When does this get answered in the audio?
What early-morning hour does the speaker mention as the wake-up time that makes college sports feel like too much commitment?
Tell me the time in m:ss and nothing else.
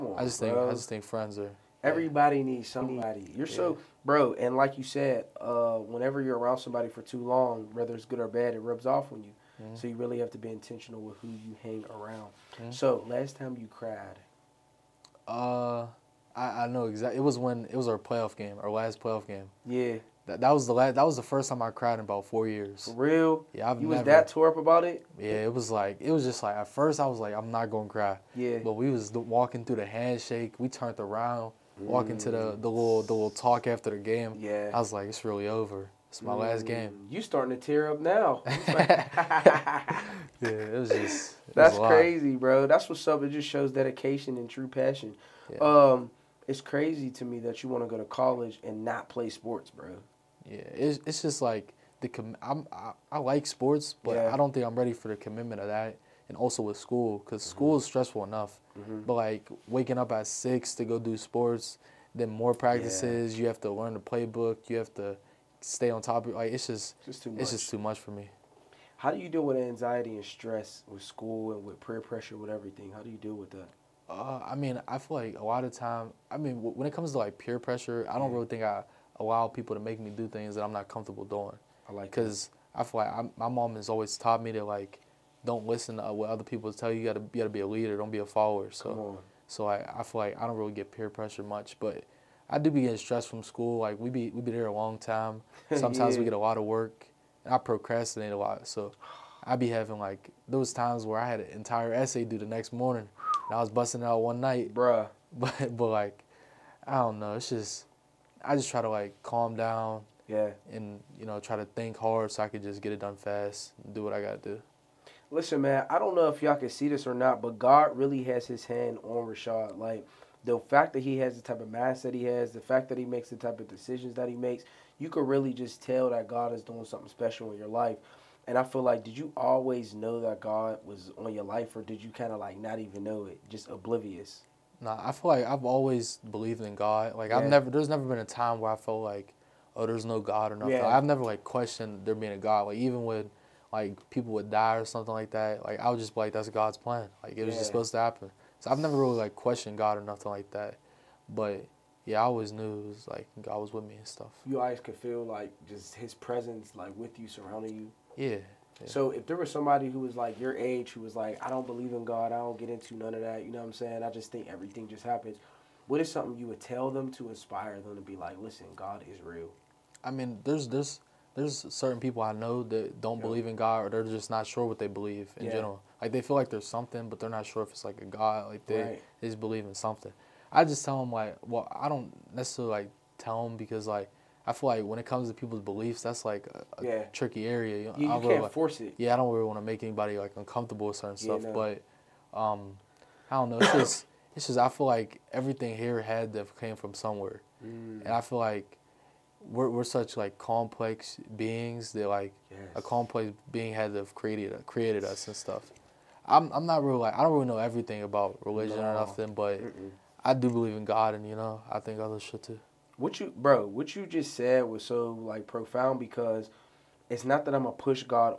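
1:00.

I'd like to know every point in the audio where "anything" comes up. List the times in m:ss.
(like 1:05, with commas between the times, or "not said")
not said.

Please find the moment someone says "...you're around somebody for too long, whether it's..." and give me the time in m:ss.
0:06.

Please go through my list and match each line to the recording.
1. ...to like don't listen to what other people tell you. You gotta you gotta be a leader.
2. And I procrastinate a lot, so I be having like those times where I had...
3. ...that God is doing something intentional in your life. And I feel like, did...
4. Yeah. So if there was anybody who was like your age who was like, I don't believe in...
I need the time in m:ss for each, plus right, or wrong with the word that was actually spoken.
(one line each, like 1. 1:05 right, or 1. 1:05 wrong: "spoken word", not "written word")
1. 1:24 right
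2. 1:37 right
3. 2:06 wrong: "special", not "intentional"
4. 2:38 wrong: "somebody", not "anybody".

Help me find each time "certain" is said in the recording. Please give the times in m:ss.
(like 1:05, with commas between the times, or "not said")
2:51, 3:10.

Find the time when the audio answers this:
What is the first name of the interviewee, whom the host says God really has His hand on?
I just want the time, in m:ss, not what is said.
1:59.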